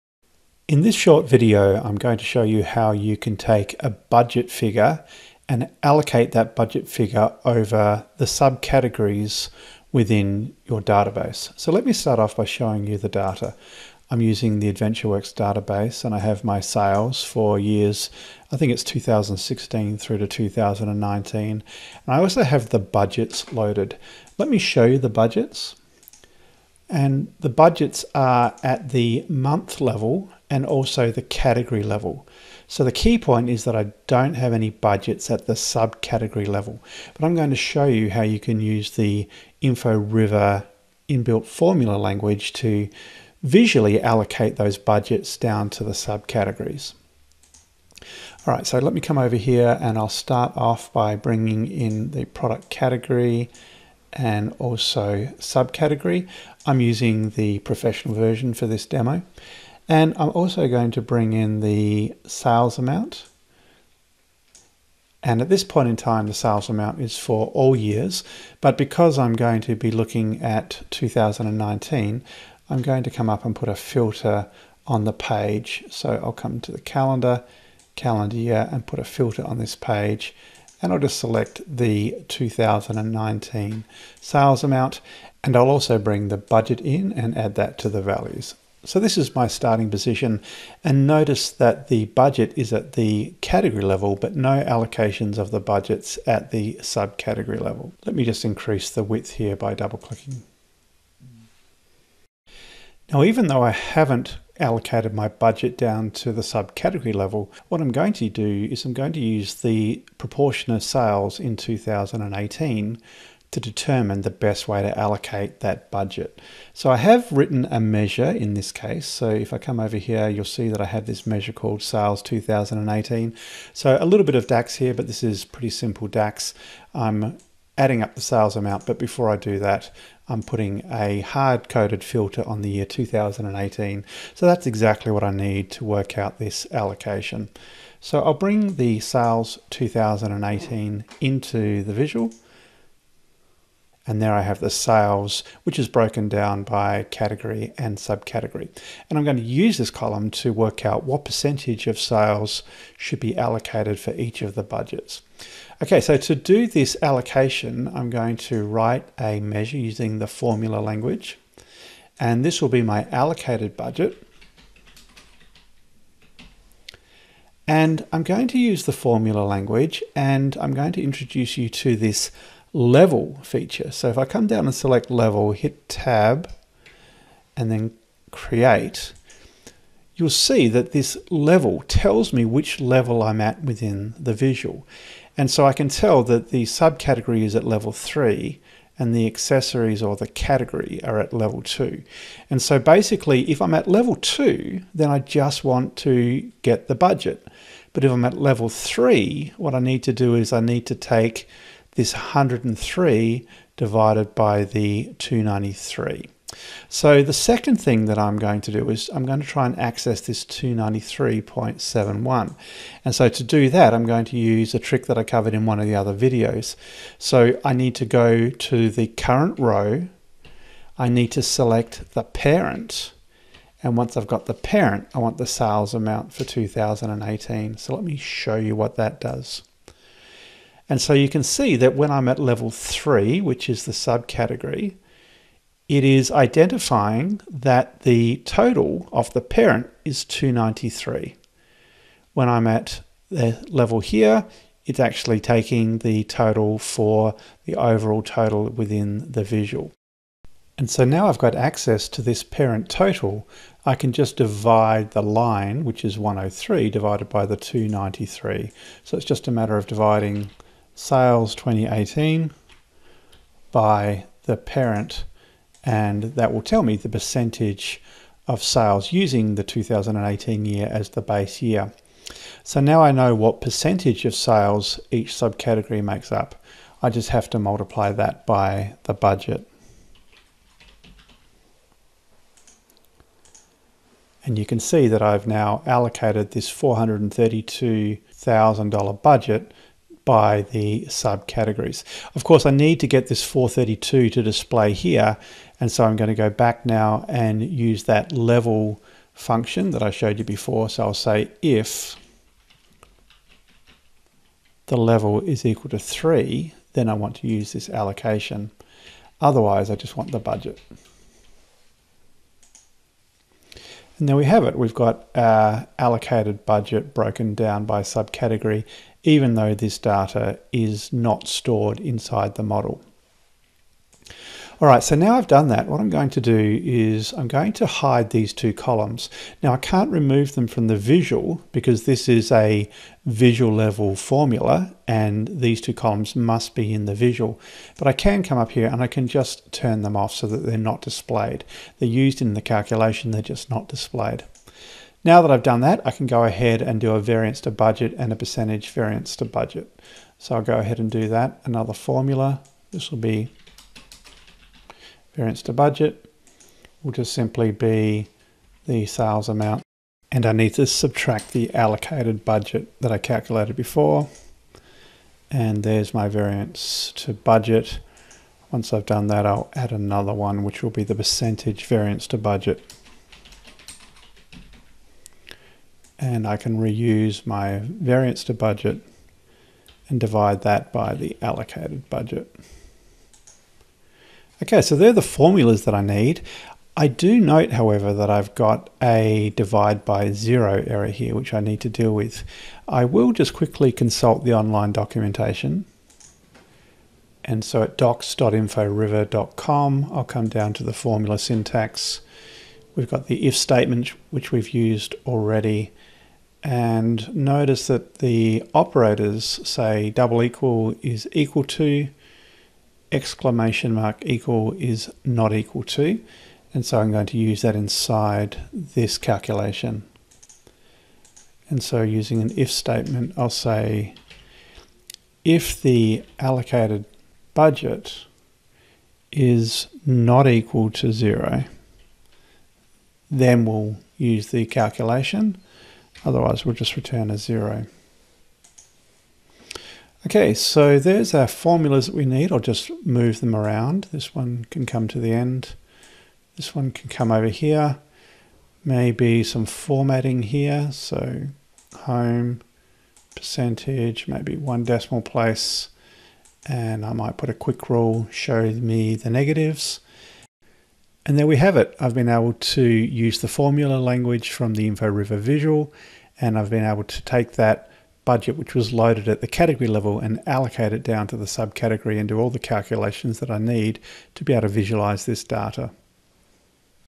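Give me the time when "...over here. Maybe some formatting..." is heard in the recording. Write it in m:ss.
7:27.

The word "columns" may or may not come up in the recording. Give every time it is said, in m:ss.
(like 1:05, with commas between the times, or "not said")
2:29, 5:28, 5:35.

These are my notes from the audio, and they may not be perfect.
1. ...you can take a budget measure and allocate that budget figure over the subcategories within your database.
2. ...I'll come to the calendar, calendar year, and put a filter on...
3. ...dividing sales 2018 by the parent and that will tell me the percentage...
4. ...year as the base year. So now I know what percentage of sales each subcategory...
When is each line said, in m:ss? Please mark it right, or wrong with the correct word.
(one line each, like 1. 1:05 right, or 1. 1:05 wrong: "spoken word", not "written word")
1. 0:02 wrong: "figure", not "measure"
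2. 1:16 right
3. 4:19 right
4. 4:30 right.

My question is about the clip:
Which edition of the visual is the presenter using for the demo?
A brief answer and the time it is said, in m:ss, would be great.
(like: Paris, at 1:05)
Professional version, at 0:57.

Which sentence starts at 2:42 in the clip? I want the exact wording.
And this will be my allocated budget.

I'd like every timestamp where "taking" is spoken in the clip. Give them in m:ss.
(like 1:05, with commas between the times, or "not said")
4:05.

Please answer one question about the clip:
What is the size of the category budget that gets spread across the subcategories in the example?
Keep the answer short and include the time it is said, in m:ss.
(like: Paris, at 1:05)
$432,000, at 4:46.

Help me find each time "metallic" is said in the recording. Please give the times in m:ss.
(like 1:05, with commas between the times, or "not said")
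not said.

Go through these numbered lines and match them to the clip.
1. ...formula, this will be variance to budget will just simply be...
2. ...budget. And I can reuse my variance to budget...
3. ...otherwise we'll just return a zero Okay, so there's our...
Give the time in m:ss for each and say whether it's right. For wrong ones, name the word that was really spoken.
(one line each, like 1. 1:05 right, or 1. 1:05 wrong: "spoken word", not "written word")
1. 5:51 right
2. 6:12 right
3. 7:16 right.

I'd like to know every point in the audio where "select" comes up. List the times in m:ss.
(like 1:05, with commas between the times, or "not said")
1:21, 2:54, 3:41.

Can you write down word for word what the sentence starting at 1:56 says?
So I have written a measure in this case.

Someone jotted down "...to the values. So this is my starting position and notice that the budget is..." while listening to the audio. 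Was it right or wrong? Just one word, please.
right.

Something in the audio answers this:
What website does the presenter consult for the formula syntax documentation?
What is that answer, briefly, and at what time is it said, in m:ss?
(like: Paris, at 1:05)
docs.inforiver.com, at 6:37.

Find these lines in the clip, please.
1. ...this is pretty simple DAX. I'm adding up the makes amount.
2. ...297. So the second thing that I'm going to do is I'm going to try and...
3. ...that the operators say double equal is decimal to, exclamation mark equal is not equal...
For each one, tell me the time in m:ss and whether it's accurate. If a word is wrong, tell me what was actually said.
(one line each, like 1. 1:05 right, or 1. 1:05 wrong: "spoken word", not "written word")
1. 2:05 wrong: "sales", not "makes"
2. 3:25 wrong: "293", not "297"
3. 6:47 wrong: "equal", not "decimal".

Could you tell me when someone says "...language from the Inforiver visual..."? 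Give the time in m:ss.
7:43.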